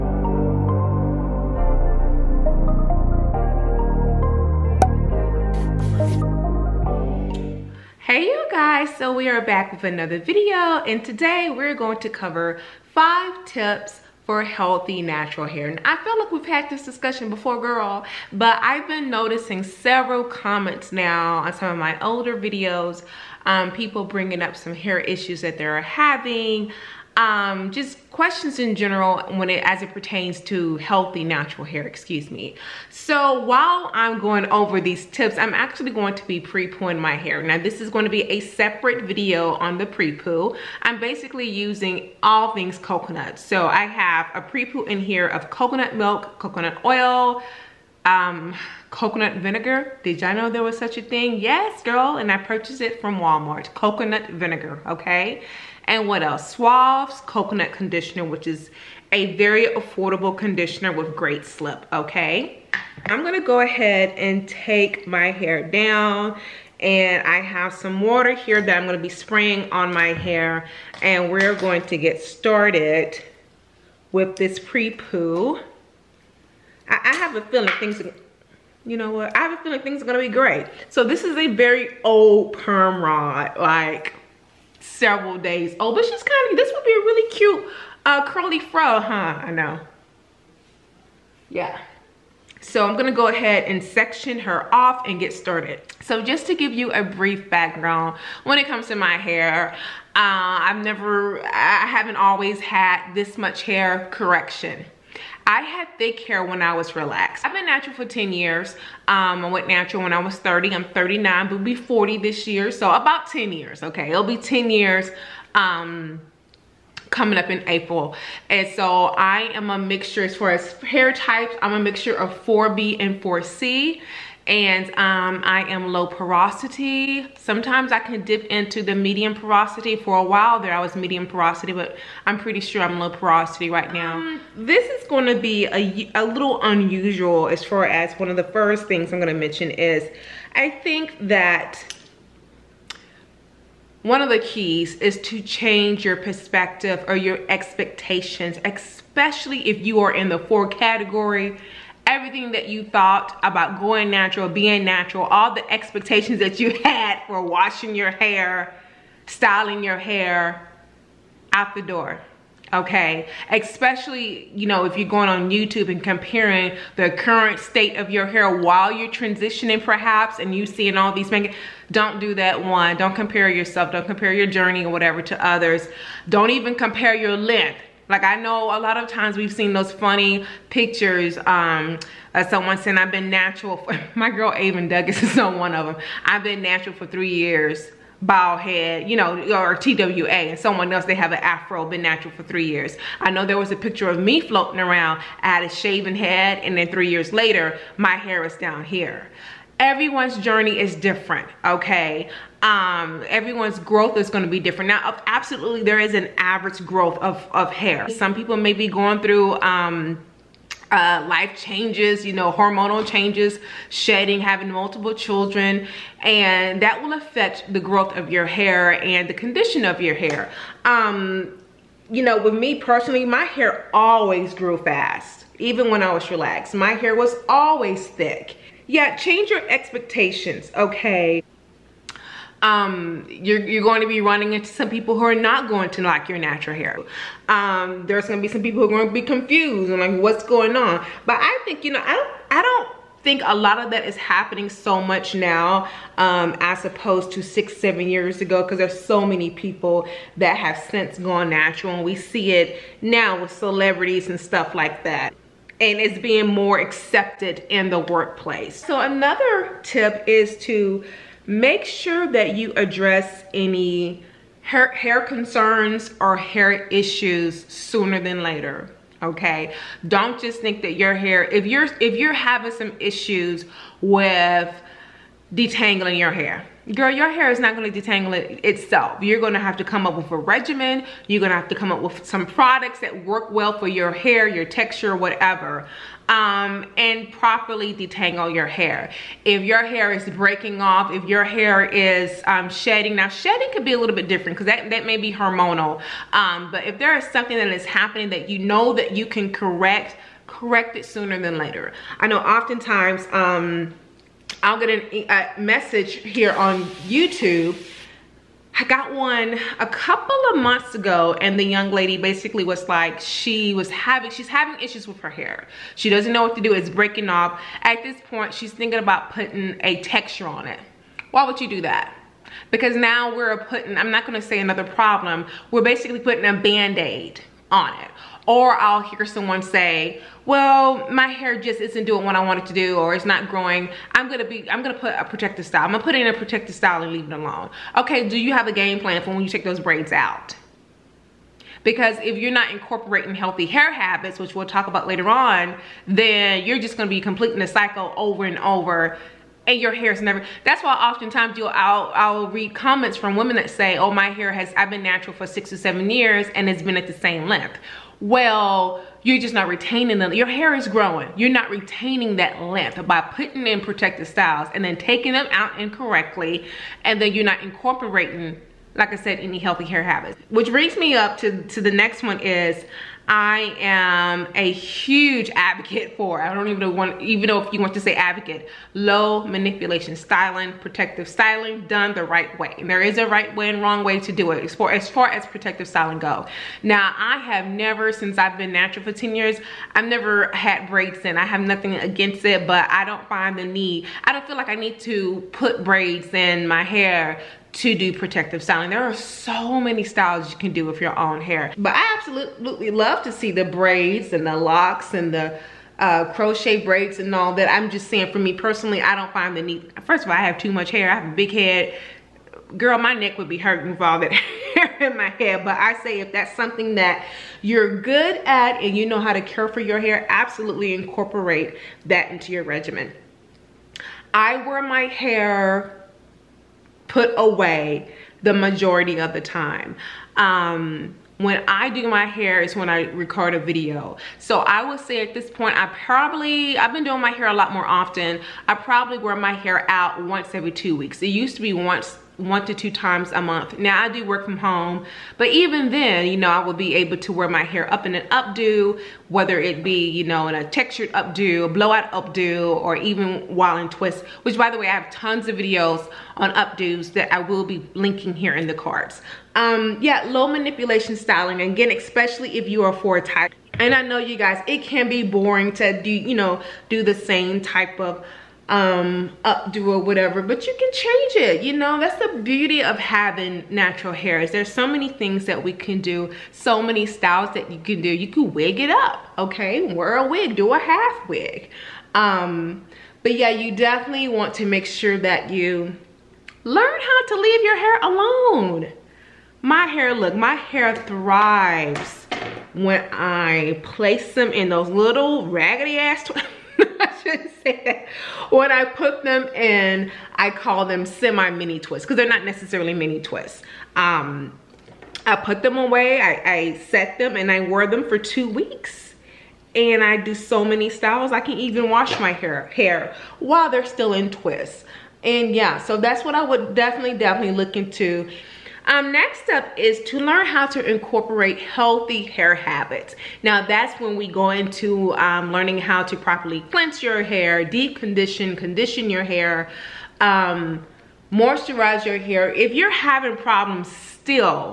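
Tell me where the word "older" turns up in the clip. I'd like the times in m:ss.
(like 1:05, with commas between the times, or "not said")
0:22.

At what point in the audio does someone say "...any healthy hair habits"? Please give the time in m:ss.
6:09.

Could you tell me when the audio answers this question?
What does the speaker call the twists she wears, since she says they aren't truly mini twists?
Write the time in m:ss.
8:21.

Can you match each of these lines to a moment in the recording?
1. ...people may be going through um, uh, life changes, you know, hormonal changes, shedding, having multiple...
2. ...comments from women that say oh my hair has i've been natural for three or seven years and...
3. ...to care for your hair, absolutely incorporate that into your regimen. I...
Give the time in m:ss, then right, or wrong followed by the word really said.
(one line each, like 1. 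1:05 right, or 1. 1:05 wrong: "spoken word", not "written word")
1. 3:28 right
2. 5:52 wrong: "six", not "three"
3. 6:59 right.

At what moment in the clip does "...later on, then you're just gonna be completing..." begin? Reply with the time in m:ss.
5:45.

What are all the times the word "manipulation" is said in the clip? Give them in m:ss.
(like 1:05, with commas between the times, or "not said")
6:19, 7:40.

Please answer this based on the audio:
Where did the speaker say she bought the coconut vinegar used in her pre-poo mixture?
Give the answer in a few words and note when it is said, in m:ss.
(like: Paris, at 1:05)
Walmart, at 0:53.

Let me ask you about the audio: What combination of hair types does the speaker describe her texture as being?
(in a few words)
4B and 4C.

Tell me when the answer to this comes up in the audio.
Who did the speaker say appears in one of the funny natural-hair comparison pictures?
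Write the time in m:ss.
3:04.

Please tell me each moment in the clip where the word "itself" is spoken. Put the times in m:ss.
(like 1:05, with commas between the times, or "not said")
4:38.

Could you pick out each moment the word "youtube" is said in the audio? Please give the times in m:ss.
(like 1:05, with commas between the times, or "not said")
2:45, 5:07.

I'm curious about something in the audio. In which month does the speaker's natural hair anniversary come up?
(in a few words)
April.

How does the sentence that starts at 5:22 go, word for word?
Because now we're putting, I'm not gonna say another problem, we're basically putting a Band-Aid on it.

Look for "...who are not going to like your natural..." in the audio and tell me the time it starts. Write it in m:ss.
3:55.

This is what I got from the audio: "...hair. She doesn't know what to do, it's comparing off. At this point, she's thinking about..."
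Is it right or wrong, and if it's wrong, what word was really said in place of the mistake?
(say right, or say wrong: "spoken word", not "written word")
wrong: "breaking", not "comparing".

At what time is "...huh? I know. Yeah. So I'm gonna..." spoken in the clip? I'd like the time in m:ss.
1:29.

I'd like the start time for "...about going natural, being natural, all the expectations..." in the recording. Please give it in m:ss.
2:33.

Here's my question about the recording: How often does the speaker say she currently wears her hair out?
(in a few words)
once every two weeks.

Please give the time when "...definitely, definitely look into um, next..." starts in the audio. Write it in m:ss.
8:36.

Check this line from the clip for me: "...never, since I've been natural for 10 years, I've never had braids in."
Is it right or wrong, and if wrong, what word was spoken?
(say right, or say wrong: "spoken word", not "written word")
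right.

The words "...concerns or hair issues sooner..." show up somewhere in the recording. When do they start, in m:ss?
4:25.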